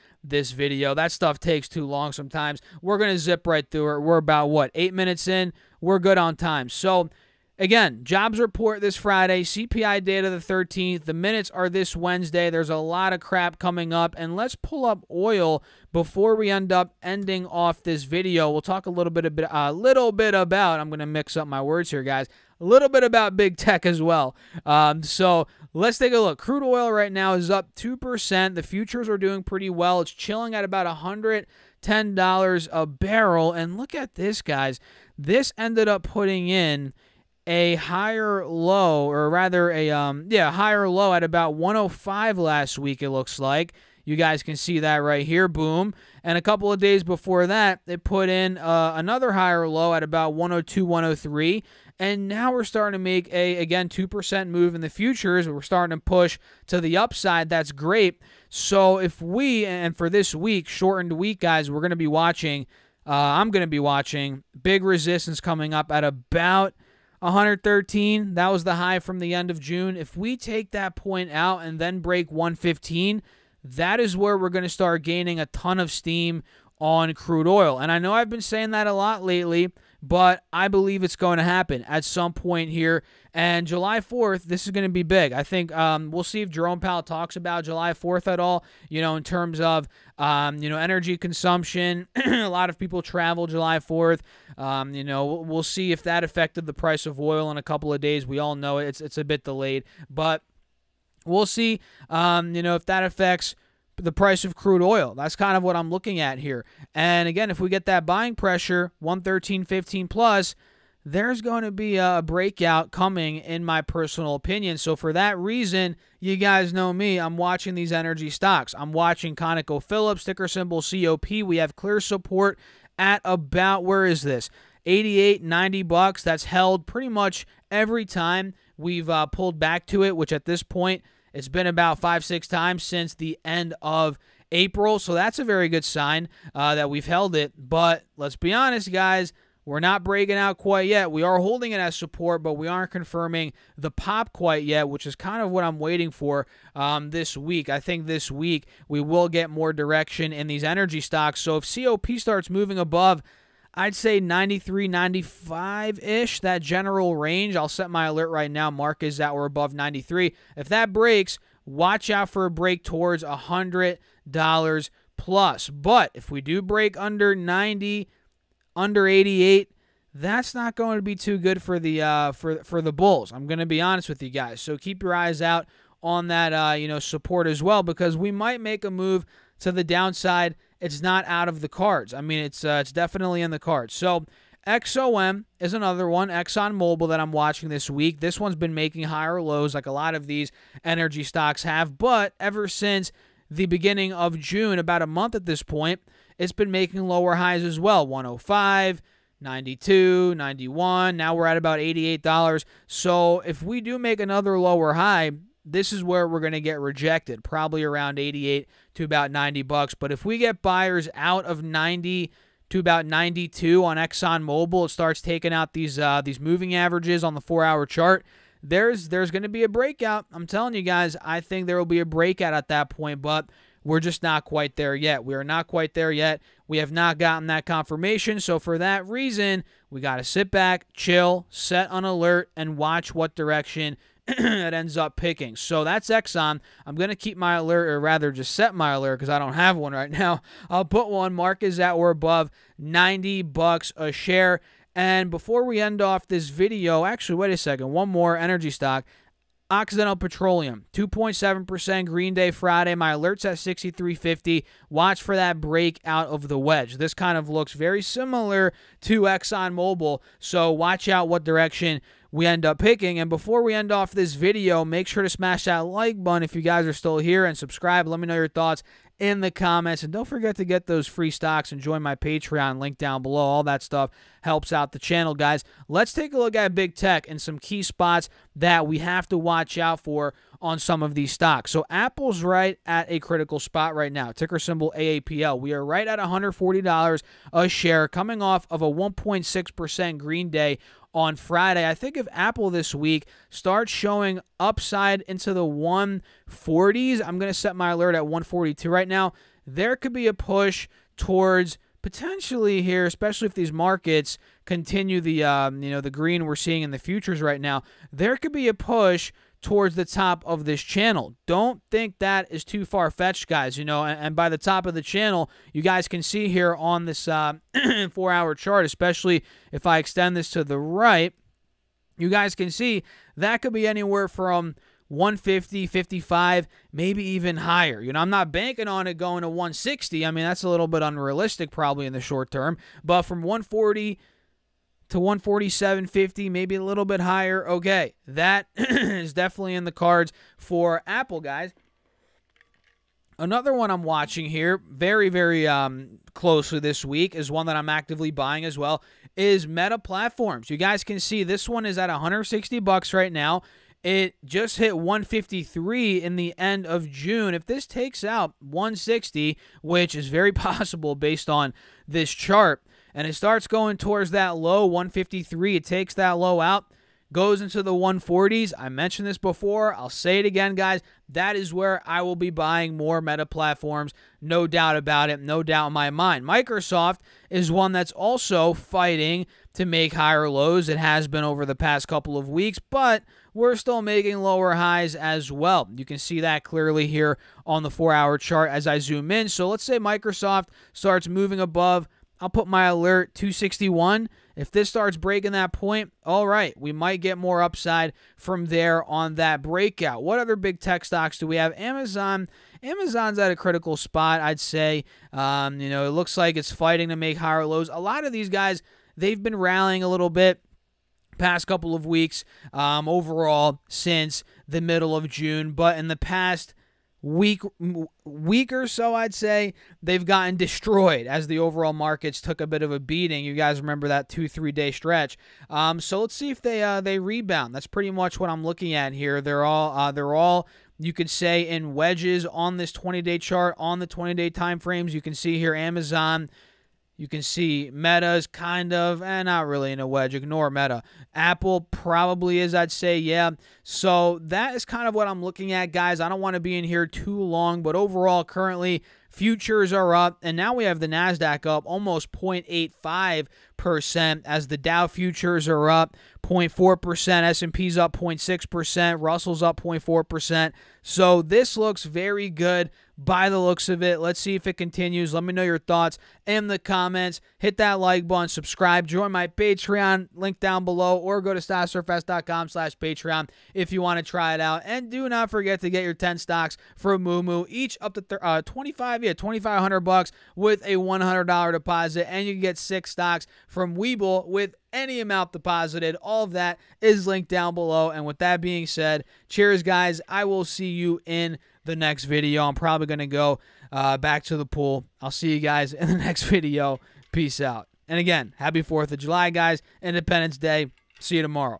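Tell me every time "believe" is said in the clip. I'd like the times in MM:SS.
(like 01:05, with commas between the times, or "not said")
01:20.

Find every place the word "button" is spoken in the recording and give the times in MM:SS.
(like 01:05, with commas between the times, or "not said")
04:26, 07:48.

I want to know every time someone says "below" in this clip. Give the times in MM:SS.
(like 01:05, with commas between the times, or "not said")
04:33, 07:50, 08:07.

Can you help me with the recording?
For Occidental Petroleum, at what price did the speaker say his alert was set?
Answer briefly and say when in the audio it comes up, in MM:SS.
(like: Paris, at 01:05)
63.50, at 04:13.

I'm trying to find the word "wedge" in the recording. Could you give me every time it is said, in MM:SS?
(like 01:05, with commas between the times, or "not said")
04:16, 07:11, 07:20.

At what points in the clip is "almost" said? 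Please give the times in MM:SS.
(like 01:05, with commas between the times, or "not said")
07:31.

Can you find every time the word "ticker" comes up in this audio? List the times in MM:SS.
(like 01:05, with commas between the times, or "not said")
02:00, 04:44.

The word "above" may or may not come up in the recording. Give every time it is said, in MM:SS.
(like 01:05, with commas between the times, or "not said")
02:32, 02:39, 04:02, 06:31.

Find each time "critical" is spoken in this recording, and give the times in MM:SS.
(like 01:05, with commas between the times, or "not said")
04:43, 06:43.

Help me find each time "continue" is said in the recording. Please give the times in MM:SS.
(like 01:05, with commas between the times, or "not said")
05:04, 07:44.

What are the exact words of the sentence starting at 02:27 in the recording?
I think this week we will get more direction in these energy stocks.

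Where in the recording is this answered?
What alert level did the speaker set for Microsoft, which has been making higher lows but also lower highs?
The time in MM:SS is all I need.
06:33.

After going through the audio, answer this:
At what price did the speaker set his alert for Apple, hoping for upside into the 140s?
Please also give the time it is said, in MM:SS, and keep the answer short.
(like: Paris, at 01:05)
142, at 04:58.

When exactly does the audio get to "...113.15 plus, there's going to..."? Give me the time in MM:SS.
01:49.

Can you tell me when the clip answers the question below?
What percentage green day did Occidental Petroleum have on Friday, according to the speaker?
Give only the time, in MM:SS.
04:10.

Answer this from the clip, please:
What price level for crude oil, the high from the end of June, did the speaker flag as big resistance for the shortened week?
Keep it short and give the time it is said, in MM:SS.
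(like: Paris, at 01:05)
113, at 01:07.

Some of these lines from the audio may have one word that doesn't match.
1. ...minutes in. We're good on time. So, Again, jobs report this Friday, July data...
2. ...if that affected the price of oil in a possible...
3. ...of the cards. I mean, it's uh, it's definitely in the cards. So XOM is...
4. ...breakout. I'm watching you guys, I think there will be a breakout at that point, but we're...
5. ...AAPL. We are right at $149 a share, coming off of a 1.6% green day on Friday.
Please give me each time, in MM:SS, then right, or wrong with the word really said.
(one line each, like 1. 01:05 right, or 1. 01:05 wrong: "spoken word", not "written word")
1. 00:04 wrong: "CPI", not "July"
2. 01:35 wrong: "couple", not "possible"
3. 03:01 right
4. 03:39 wrong: "telling", not "watching"
5. 04:44 wrong: "140", not "149".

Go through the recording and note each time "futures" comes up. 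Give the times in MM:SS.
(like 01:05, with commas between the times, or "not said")
00:28, 00:54, 05:06, 07:29, 07:35.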